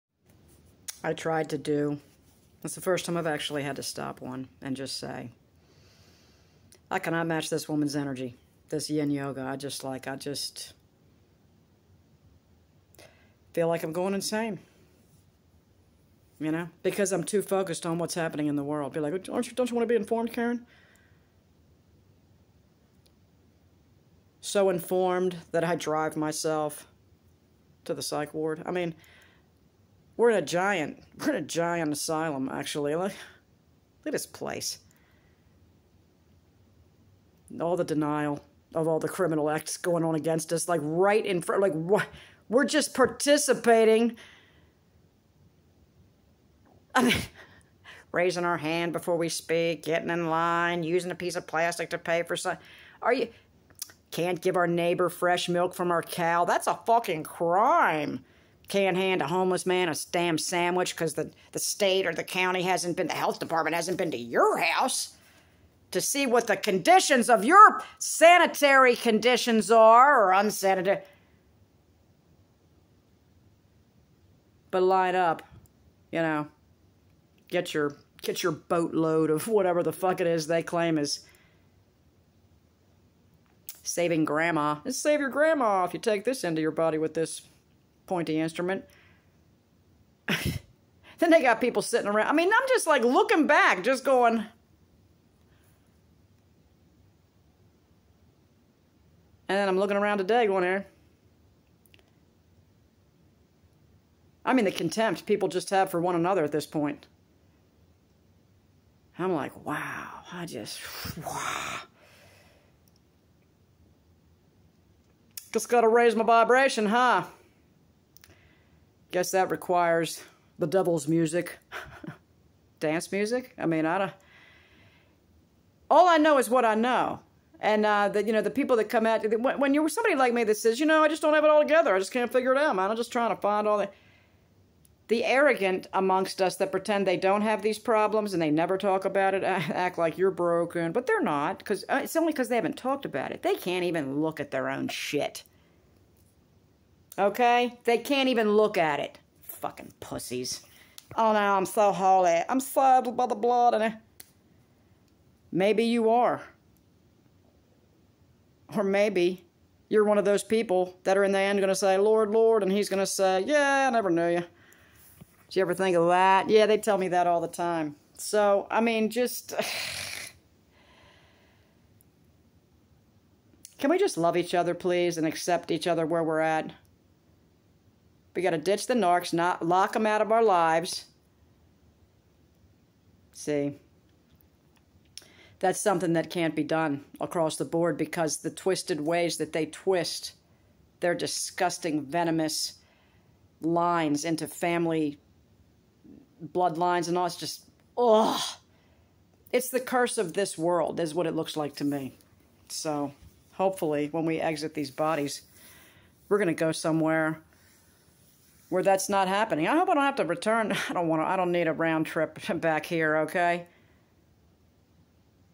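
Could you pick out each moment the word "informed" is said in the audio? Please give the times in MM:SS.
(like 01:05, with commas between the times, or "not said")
00:19, 00:24.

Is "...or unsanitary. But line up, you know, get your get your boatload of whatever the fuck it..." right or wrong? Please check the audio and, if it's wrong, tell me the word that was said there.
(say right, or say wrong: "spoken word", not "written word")
right.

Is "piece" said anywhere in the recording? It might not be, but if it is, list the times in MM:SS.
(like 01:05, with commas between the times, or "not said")
00:51.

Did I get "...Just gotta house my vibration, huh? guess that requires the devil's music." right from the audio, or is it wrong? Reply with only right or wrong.
wrong.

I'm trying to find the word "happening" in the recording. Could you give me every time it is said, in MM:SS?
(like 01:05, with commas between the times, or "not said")
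00:18, 03:29.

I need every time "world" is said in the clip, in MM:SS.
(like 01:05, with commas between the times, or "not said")
00:18, 03:20.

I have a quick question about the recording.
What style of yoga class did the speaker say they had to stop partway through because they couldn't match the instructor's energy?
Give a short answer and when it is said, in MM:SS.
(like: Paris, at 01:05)
yin yoga, at 00:08.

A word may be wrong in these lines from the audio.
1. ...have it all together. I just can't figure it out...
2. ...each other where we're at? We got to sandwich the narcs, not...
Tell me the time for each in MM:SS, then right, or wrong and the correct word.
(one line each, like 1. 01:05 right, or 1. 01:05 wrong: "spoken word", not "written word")
1. 02:11 right
2. 02:55 wrong: "ditch", not "sandwich".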